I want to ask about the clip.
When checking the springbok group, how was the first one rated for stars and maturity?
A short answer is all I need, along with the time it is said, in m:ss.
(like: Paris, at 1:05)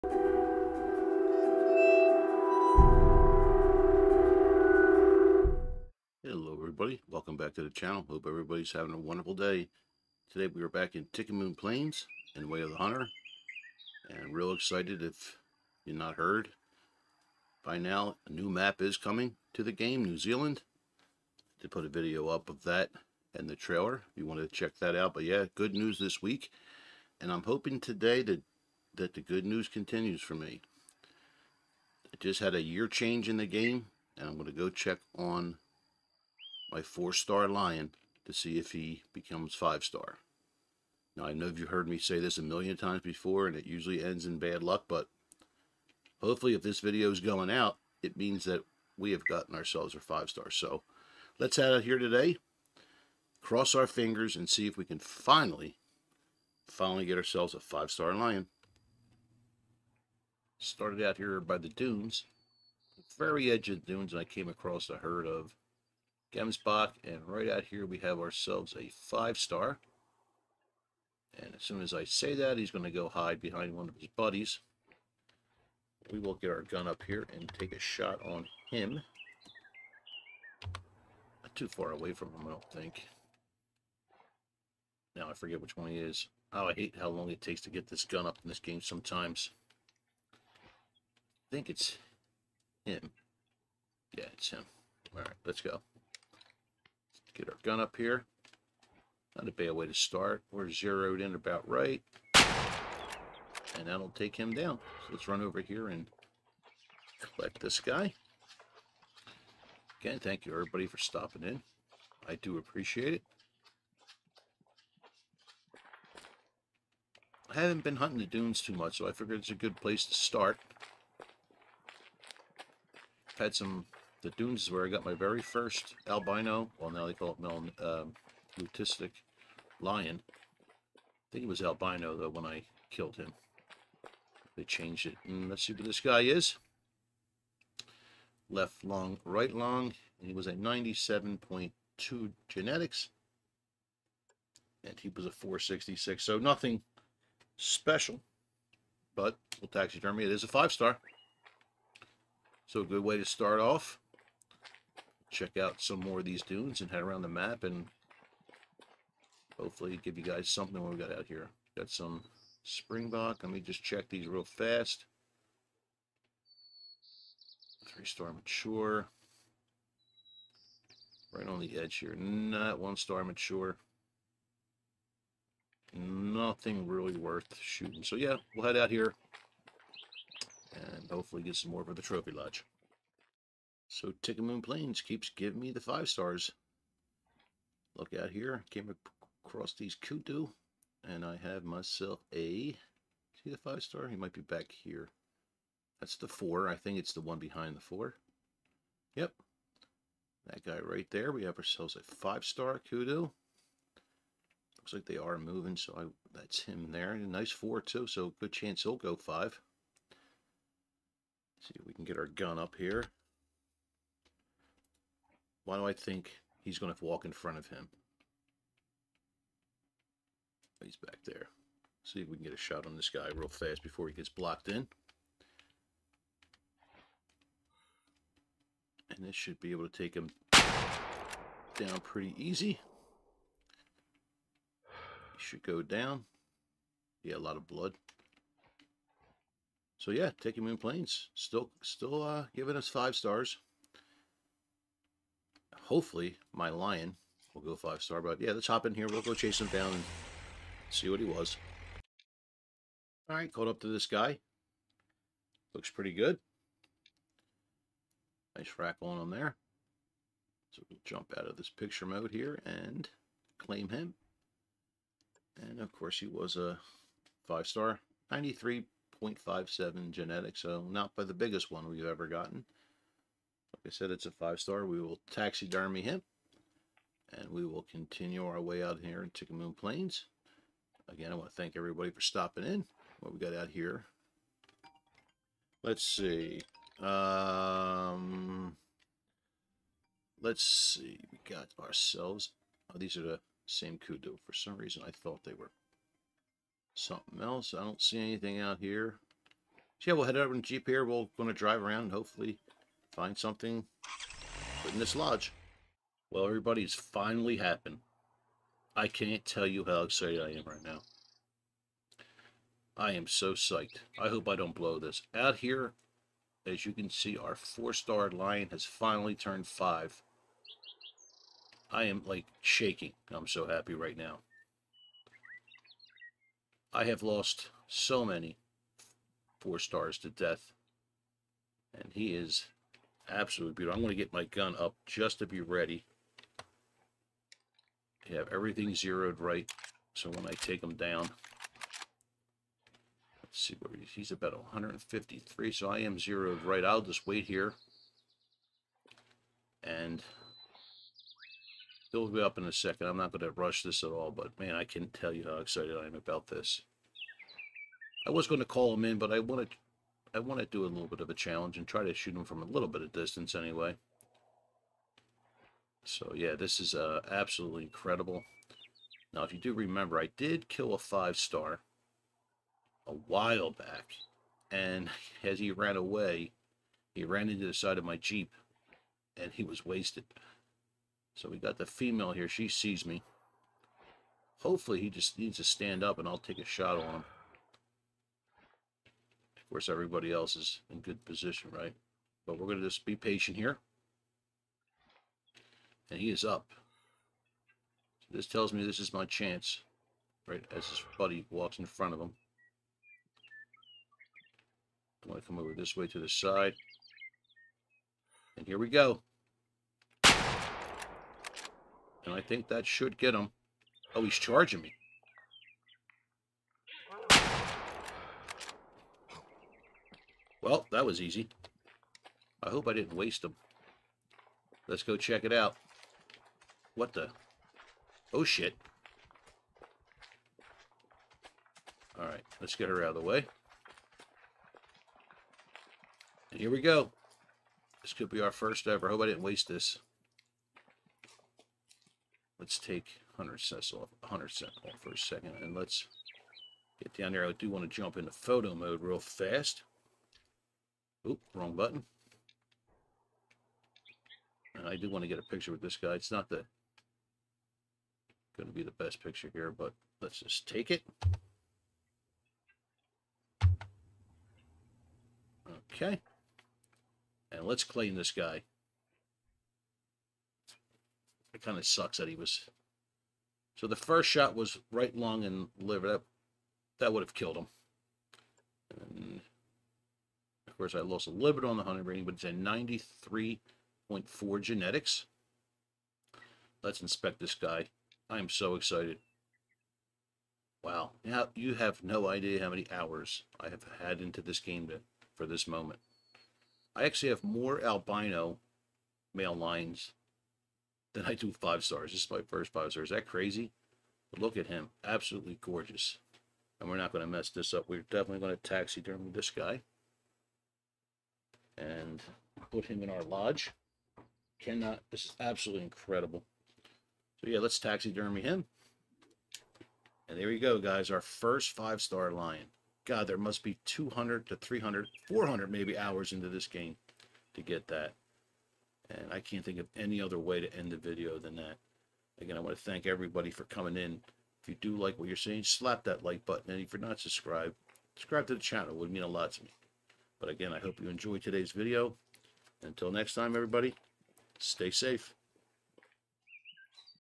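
Three-star mature, at 2:47.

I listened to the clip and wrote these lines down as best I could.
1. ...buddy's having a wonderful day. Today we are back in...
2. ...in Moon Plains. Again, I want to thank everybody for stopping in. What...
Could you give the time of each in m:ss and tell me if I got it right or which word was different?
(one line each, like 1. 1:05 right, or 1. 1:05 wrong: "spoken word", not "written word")
1. 0:08 wrong: "everybody", not "buddy"
2. 4:39 right.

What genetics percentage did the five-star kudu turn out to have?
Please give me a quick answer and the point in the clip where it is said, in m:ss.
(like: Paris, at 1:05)
93.57, at 4:28.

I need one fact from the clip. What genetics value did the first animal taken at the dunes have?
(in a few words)
97.2.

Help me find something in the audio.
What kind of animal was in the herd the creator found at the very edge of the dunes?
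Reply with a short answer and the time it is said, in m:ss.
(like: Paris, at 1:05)
Gemsbok, at 1:06.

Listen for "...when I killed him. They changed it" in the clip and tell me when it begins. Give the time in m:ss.
2:12.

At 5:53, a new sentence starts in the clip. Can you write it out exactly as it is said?
I'm not going to rush this at all, but man, I can not tell you how excited I am about this.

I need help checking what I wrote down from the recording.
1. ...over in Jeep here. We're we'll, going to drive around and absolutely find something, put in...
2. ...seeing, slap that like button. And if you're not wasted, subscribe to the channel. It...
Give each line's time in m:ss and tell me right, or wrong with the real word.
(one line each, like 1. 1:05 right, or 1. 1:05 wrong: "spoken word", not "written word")
1. 5:00 wrong: "hopefully", not "absolutely"
2. 8:55 wrong: "subscribed", not "wasted".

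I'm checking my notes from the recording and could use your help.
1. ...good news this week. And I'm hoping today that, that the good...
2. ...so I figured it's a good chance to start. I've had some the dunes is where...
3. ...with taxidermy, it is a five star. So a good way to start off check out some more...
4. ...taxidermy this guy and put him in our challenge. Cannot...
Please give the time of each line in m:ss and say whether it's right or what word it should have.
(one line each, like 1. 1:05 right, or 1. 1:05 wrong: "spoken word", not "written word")
1. 0:25 right
2. 1:58 wrong: "place", not "chance"
3. 2:29 right
4. 8:28 wrong: "lodge", not "challenge".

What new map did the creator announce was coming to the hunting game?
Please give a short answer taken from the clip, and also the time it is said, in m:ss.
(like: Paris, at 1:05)
New Zealand, at 0:20.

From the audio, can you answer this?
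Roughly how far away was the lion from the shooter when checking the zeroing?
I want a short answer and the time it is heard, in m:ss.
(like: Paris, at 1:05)
153, at 5:44.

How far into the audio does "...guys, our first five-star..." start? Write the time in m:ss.
8:40.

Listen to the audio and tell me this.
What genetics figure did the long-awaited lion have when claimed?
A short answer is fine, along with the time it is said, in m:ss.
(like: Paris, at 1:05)
93.4, at 8:02.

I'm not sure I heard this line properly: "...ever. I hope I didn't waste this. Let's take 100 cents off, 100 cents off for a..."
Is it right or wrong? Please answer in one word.
right.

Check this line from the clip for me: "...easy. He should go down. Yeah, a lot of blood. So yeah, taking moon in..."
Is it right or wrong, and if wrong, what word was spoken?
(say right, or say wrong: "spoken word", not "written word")
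right.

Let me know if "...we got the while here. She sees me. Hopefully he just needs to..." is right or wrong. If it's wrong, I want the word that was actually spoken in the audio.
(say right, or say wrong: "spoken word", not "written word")
wrong: "female", not "while".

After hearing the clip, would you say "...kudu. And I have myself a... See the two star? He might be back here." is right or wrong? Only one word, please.
wrong.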